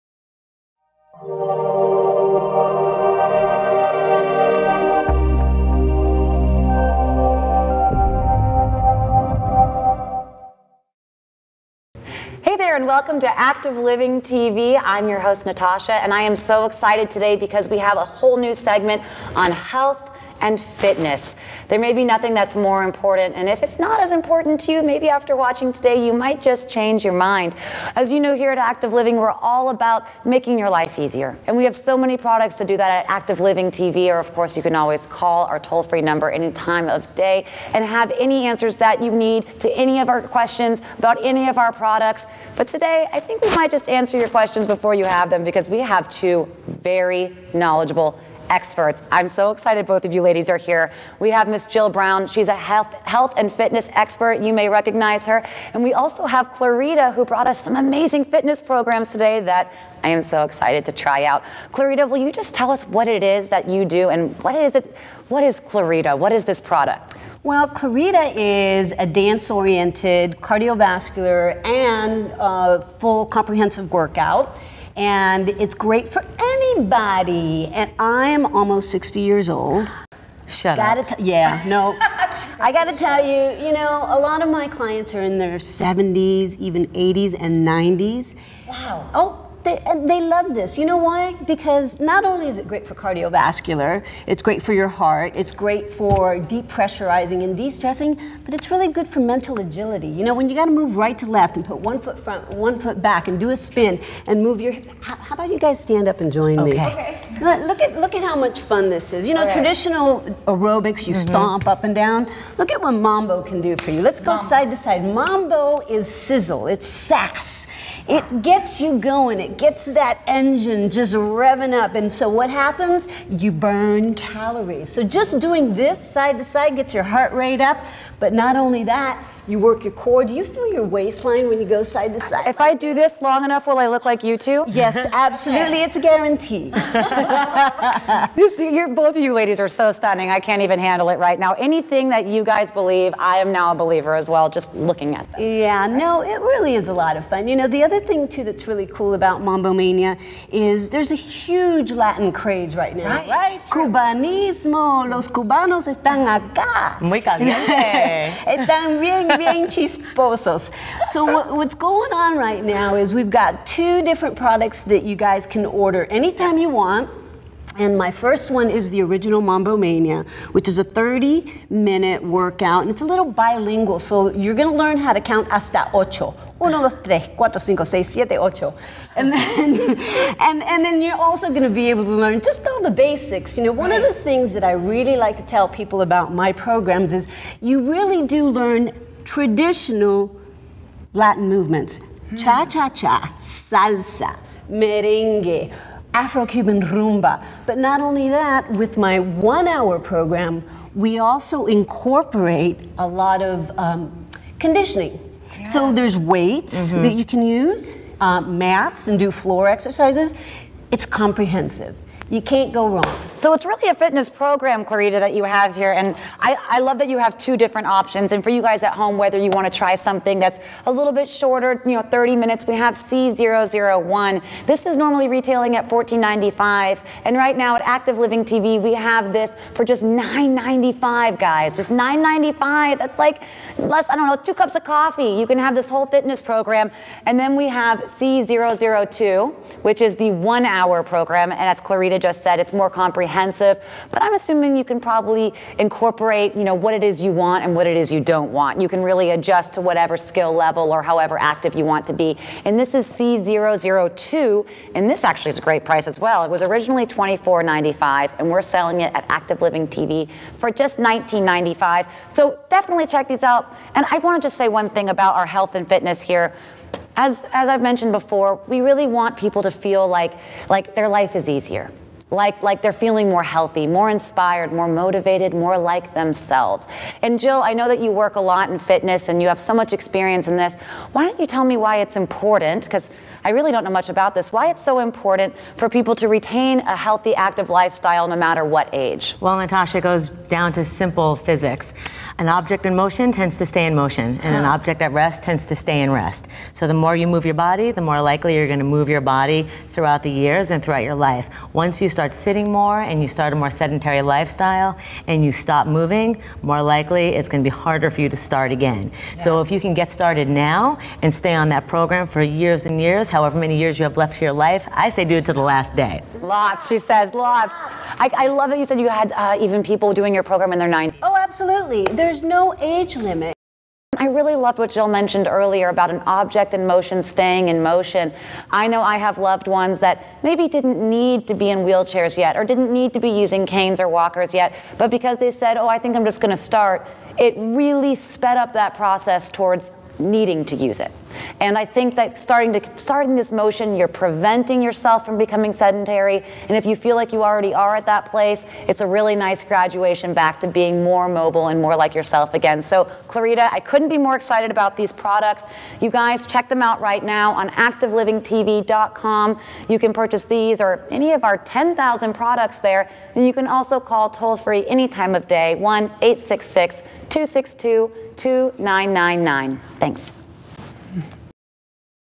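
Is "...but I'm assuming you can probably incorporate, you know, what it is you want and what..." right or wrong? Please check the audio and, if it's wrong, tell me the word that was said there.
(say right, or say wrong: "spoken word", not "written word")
right.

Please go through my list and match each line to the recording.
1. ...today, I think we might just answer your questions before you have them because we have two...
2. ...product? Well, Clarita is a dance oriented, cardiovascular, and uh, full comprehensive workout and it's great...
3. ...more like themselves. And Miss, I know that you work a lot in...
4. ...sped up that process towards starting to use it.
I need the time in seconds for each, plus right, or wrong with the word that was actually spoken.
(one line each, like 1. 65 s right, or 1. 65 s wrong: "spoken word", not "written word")
1. 42 s right
2. 66 s right
3. 275 s wrong: "Jill", not "Miss"
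4. 338 s wrong: "needing", not "starting".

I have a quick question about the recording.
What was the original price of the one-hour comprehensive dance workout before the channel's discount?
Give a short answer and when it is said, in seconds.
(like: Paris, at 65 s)
$24.95, at 257 s.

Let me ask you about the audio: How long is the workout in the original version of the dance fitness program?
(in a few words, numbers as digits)
30 minutes.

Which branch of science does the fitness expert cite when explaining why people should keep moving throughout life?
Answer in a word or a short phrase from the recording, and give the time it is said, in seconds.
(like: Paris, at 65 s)
Physics, at 291 s.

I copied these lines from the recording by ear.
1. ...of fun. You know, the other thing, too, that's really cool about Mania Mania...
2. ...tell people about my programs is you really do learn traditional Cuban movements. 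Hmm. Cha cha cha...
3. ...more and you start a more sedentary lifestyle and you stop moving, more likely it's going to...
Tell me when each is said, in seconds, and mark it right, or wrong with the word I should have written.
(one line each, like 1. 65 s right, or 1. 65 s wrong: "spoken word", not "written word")
1. 147 s wrong: "Mambo", not "Mania"
2. 185 s wrong: "Latin", not "Cuban"
3. 302 s right.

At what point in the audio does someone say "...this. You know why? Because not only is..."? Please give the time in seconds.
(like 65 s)
90 s.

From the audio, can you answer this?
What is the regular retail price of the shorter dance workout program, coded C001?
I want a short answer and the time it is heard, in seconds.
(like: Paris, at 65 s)
$14.95, at 225 s.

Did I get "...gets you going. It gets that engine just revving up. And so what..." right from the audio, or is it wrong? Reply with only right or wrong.
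right.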